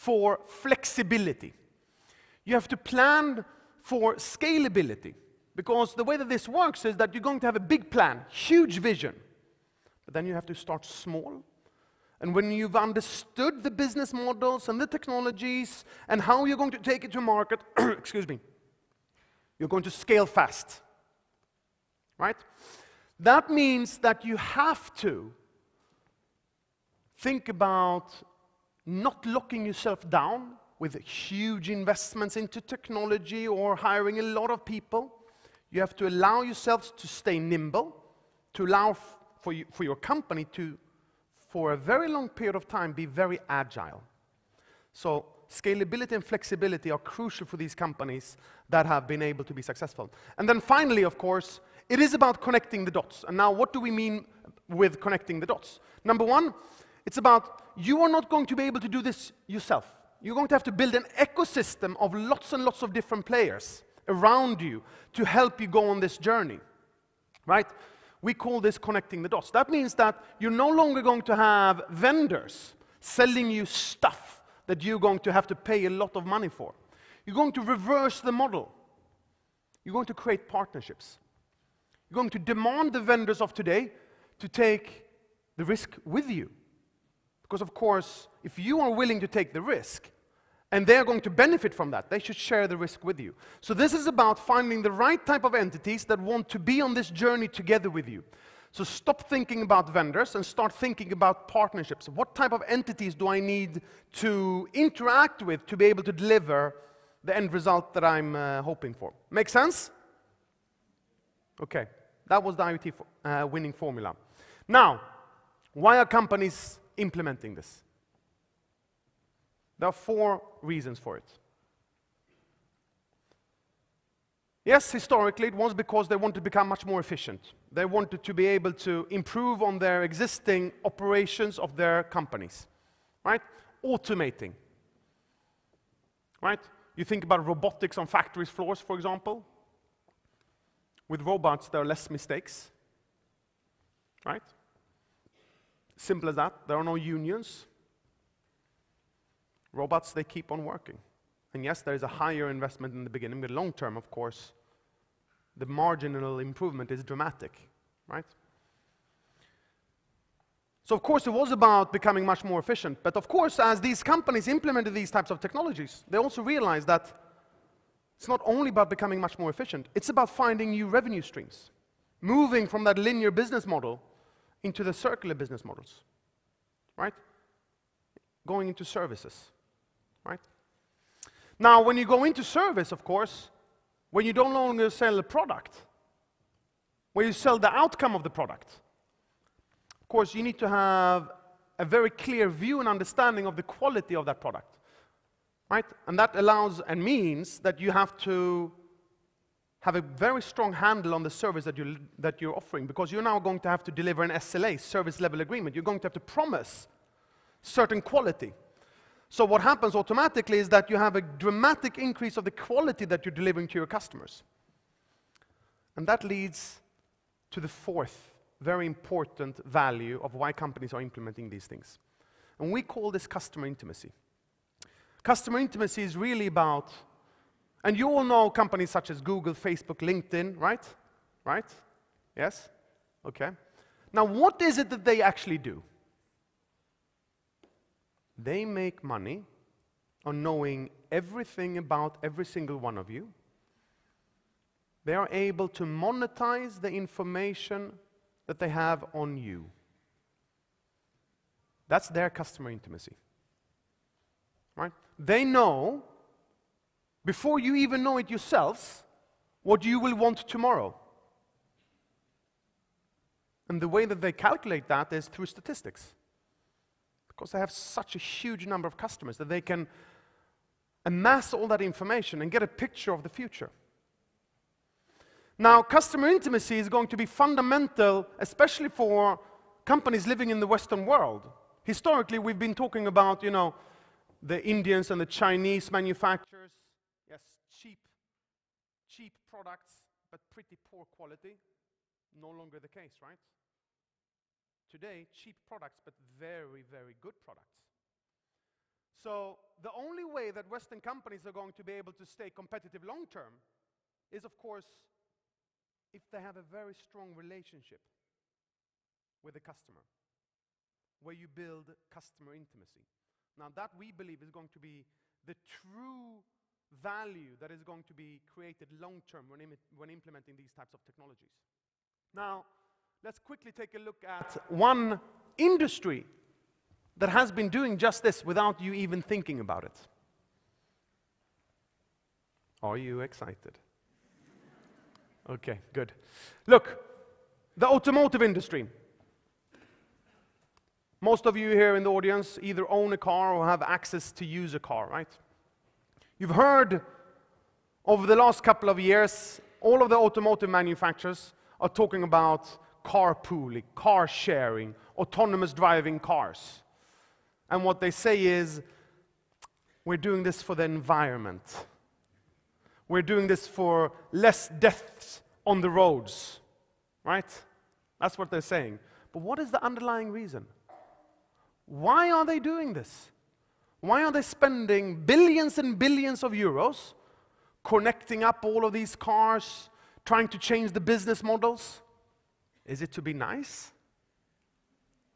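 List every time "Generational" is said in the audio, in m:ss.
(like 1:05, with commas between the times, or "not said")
not said.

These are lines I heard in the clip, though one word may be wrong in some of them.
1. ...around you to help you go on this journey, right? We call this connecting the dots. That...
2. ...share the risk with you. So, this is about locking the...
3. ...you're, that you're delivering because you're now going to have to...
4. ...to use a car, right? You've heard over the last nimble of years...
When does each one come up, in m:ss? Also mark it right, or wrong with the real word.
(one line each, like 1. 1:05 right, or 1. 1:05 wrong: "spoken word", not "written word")
1. 1:04 right
2. 1:32 wrong: "finding", not "locking"
3. 3:21 wrong: "offering", not "delivering"
4. 5:44 wrong: "couple", not "nimble".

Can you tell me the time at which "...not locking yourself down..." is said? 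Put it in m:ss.
0:28.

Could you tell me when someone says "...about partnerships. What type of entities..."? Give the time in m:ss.
1:41.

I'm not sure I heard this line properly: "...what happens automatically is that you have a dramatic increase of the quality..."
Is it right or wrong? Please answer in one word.
right.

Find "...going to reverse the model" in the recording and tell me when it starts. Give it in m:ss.
1:17.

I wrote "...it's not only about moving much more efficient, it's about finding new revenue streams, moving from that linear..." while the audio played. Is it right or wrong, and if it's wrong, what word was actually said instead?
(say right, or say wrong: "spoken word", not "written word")
wrong: "becoming", not "moving".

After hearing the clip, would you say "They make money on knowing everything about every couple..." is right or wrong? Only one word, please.
wrong.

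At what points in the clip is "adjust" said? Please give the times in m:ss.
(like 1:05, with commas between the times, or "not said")
not said.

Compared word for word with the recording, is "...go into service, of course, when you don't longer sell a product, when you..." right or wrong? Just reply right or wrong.
right.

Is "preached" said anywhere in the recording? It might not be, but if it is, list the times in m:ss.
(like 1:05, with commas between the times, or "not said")
not said.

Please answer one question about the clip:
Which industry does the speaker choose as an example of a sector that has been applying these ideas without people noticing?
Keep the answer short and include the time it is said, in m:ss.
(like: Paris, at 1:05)
Automotive industry, at 5:37.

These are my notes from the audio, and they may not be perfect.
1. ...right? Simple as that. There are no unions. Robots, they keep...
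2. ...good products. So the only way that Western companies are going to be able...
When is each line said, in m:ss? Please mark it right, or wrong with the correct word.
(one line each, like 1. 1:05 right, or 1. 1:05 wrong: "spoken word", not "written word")
1. 2:24 right
2. 4:57 right.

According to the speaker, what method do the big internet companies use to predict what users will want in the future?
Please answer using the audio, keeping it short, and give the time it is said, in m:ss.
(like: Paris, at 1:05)
Statistics, at 4:25.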